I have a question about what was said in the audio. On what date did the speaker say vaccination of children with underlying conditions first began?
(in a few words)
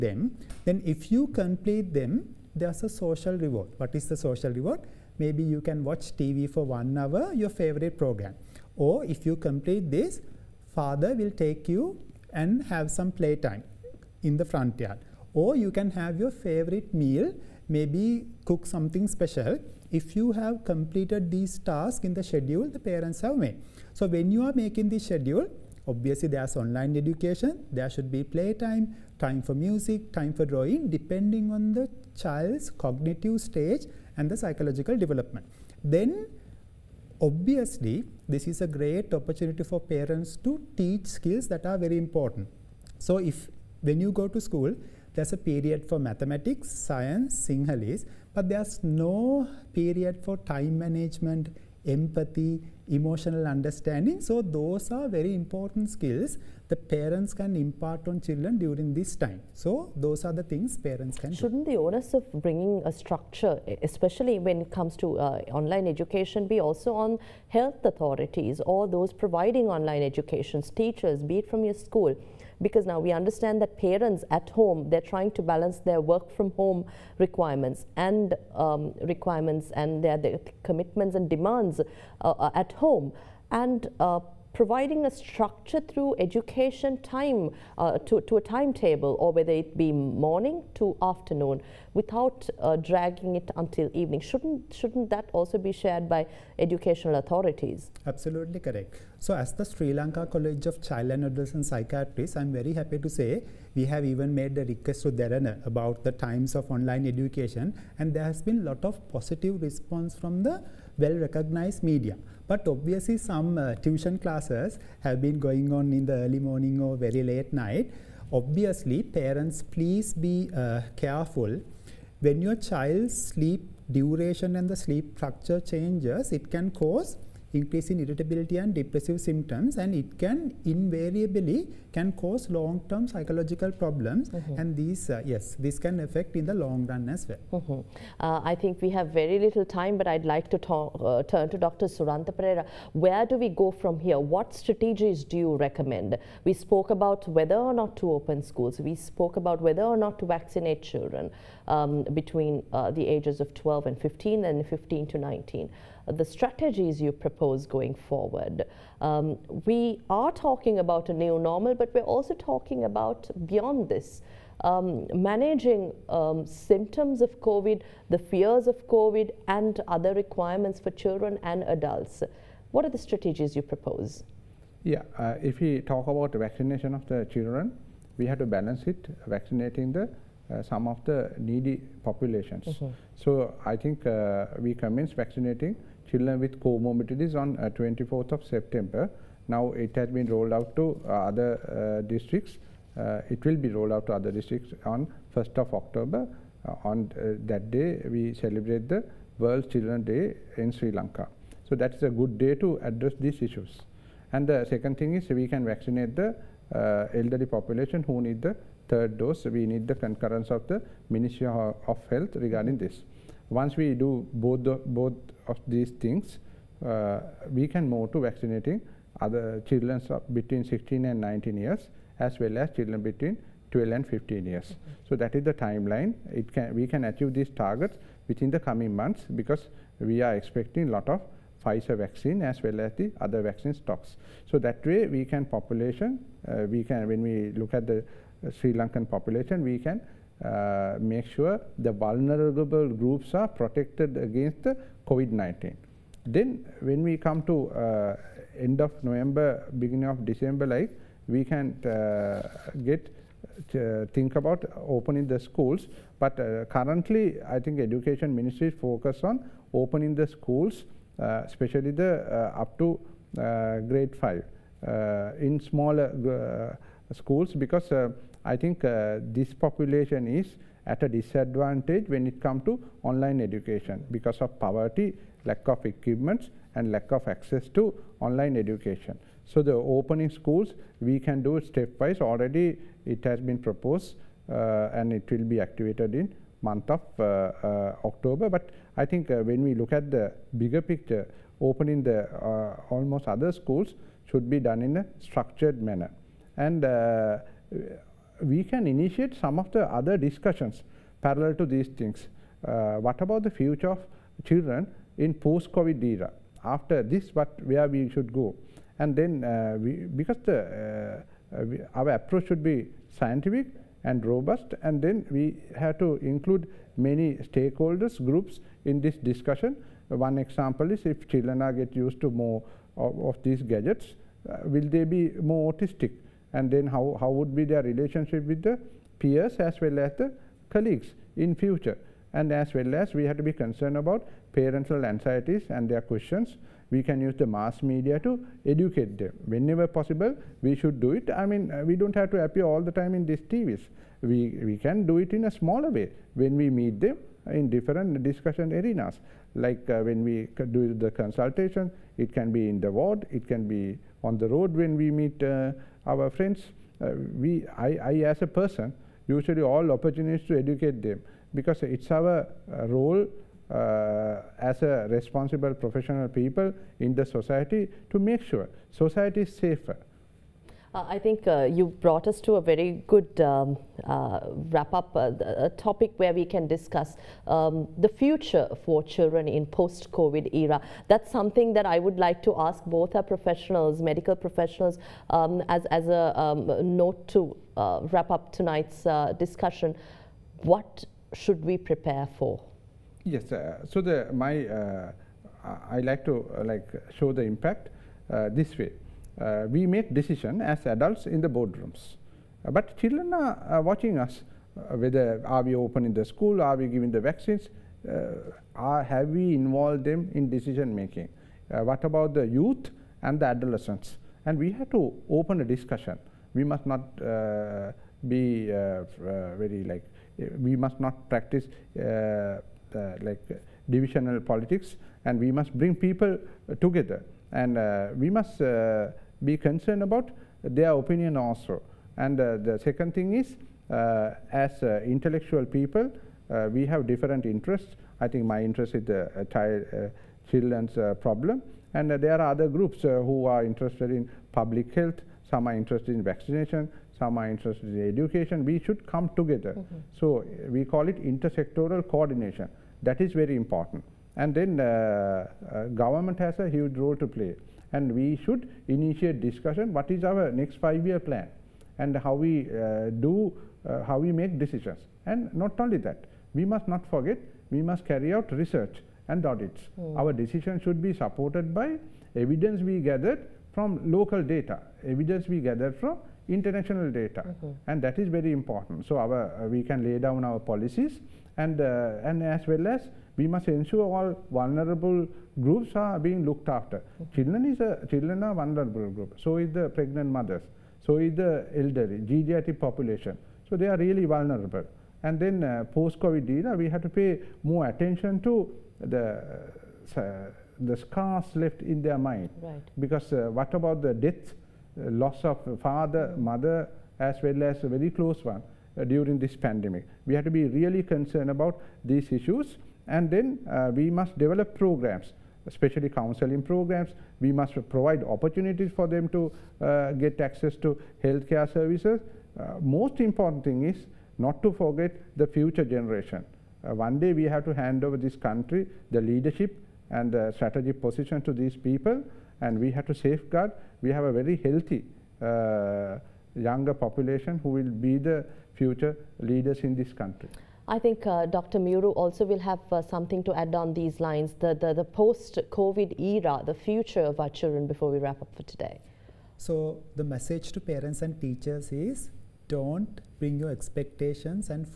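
24th of September.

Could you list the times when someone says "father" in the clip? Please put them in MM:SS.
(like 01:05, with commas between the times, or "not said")
00:10, 08:25.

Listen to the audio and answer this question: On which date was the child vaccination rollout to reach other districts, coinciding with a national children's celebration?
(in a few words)
1st of October.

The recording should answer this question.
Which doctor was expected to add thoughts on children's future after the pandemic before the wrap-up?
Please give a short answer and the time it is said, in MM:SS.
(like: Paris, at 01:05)
Dr. Miyuru, at 09:01.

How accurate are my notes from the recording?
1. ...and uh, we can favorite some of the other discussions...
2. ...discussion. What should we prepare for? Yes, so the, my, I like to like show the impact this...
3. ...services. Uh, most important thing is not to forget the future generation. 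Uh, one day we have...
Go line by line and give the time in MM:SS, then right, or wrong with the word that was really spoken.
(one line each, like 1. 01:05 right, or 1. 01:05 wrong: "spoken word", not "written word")
1. 04:56 wrong: "initiate", not "favorite"
2. 06:29 right
3. 08:41 right.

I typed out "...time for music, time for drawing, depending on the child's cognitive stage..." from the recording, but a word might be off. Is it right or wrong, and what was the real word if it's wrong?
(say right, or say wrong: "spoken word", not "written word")
right.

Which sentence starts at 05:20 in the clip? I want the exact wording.
One example is if children are get used to more of, of these gadgets, uh, will they be more autistic?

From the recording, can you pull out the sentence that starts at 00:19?
If you have completed these tasks in the schedule the parents have made.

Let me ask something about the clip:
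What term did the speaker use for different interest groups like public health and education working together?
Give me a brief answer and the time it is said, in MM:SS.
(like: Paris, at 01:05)
intersectoral coordination, at 07:31.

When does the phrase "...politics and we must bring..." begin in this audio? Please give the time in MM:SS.
07:04.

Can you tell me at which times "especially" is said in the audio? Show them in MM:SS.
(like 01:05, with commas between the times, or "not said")
01:03, 04:21, 08:35.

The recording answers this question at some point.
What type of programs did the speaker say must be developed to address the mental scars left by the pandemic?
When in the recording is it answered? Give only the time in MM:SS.
08:36.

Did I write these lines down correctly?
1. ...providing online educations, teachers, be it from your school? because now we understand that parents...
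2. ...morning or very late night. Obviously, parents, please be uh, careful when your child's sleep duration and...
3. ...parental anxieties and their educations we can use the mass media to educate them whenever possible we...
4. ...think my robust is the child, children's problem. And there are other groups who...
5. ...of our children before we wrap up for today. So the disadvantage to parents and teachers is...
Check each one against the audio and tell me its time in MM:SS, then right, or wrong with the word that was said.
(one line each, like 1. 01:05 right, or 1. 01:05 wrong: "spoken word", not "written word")
1. 01:09 right
2. 01:56 right
3. 05:34 wrong: "questions", not "educations"
4. 07:18 wrong: "interest", not "robust"
5. 09:07 wrong: "message", not "disadvantage".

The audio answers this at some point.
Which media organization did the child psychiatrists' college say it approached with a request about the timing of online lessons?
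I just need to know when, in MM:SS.
01:45.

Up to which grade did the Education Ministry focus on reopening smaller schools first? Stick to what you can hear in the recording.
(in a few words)
grade five.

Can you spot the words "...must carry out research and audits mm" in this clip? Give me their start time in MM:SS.
07:47.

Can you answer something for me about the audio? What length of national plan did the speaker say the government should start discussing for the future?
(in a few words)
five year plan.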